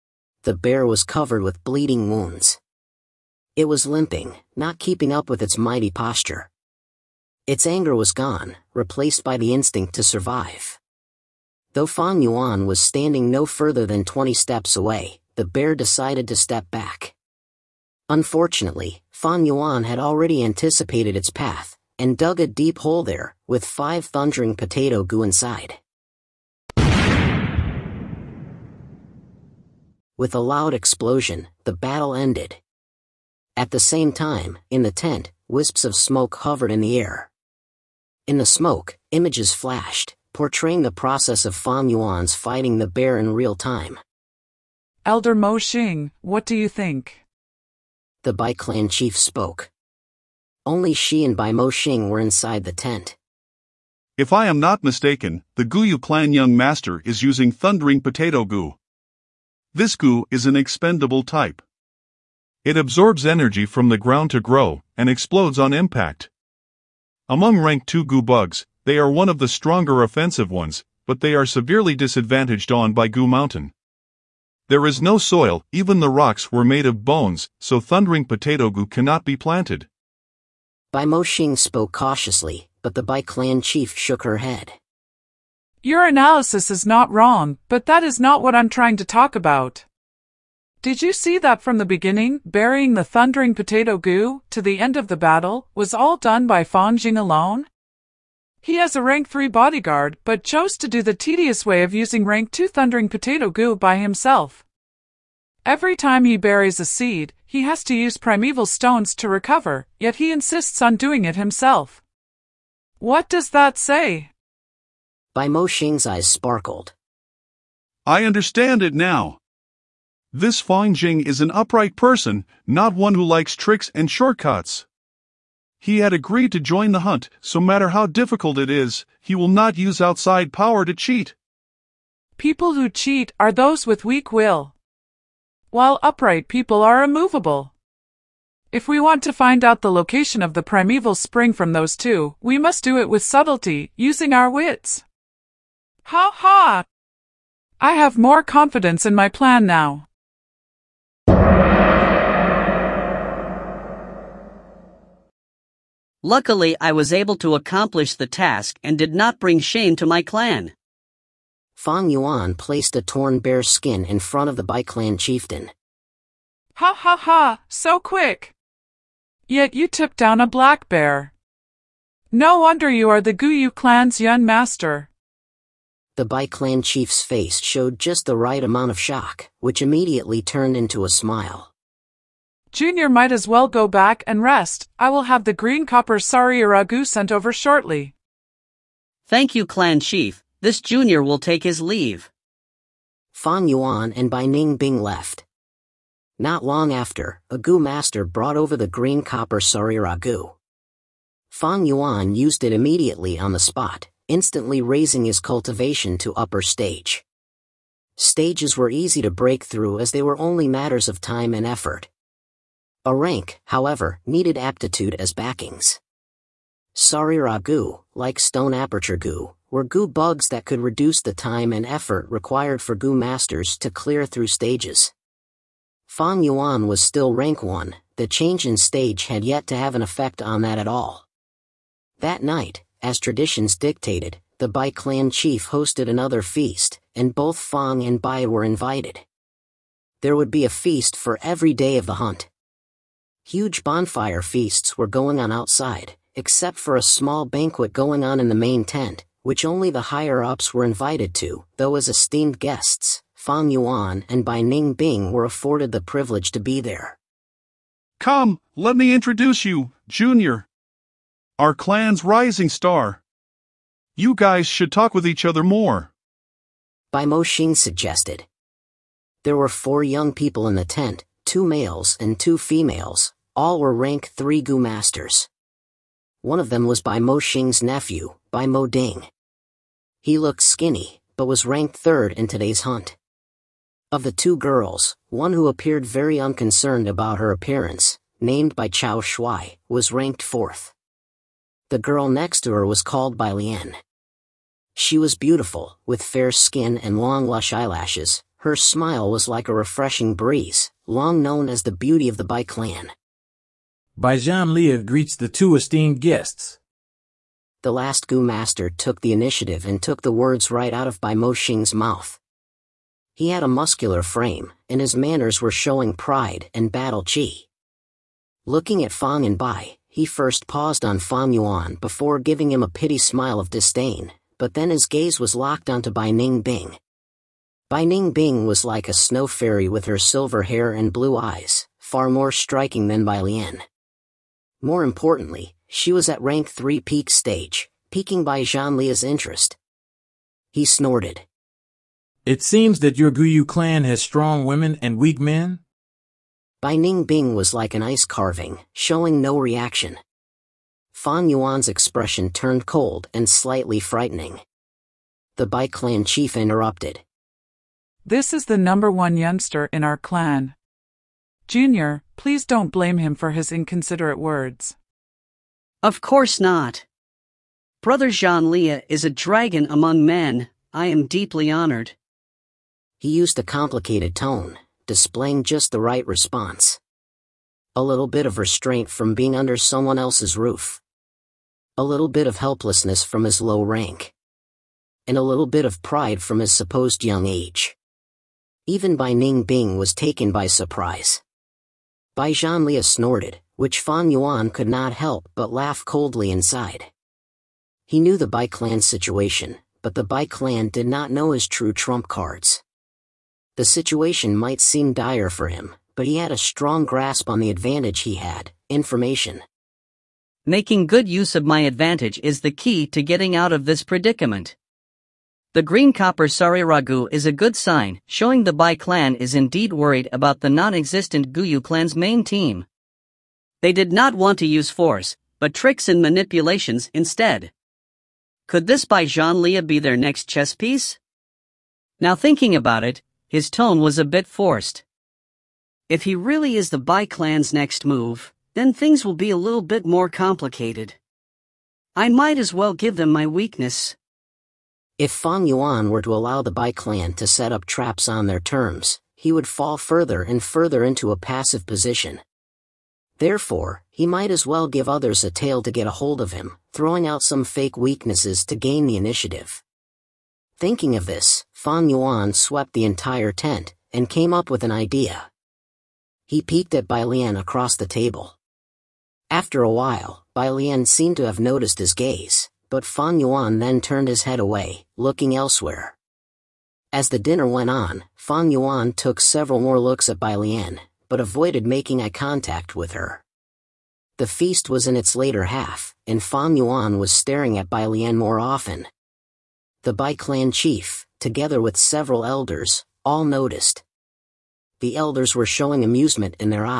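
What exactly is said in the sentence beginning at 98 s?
He has a rank 3 bodyguard, but chose to do the tedious way of using rank 2 thundering potato Gu by himself.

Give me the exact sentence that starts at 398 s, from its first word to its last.
He knew the Bai clan's situation, but the Bai clan did not know his true trump cards.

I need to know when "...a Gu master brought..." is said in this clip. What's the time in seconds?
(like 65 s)
197 s.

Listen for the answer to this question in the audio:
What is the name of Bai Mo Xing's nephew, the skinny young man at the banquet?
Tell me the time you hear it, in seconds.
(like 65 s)
278 s.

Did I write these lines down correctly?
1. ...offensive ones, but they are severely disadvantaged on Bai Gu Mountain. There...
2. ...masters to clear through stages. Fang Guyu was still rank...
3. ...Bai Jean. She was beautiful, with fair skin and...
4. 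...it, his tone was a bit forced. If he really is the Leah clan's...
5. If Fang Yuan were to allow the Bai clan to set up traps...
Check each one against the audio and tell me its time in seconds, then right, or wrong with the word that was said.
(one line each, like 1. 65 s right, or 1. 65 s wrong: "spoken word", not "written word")
1. 70 s right
2. 223 s wrong: "Yuan", not "Guyu"
3. 293 s wrong: "Lian", not "Jean"
4. 433 s wrong: "Bai", not "Leah"
5. 445 s right.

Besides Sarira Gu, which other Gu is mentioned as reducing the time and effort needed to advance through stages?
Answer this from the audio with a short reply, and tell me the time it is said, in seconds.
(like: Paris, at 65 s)
stone aperture Gu, at 218 s.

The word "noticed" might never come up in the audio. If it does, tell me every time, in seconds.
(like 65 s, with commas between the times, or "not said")
471 s, 493 s.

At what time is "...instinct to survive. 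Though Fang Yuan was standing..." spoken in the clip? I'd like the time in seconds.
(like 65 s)
9 s.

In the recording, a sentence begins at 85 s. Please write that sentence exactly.
Your analysis is not wrong, but that is not what I'm trying to talk about.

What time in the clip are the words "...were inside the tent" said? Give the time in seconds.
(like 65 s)
52 s.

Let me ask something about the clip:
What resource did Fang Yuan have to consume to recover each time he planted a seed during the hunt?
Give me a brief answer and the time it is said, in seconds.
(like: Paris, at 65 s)
primeval stones, at 108 s.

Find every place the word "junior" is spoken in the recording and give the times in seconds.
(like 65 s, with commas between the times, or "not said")
182 s, 190 s, 260 s, 361 s.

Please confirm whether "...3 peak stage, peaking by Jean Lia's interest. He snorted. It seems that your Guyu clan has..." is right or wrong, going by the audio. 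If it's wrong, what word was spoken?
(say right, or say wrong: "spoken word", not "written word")
right.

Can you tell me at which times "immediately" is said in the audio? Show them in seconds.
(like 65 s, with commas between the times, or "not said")
179 s, 202 s.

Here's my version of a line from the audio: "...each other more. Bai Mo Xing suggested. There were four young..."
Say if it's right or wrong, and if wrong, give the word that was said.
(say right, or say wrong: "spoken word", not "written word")
right.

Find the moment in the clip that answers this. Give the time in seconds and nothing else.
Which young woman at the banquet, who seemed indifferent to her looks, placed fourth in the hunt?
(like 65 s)
288 s.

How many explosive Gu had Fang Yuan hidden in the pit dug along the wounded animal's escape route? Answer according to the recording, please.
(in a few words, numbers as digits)
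5.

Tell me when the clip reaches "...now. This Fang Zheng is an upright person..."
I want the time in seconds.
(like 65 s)
118 s.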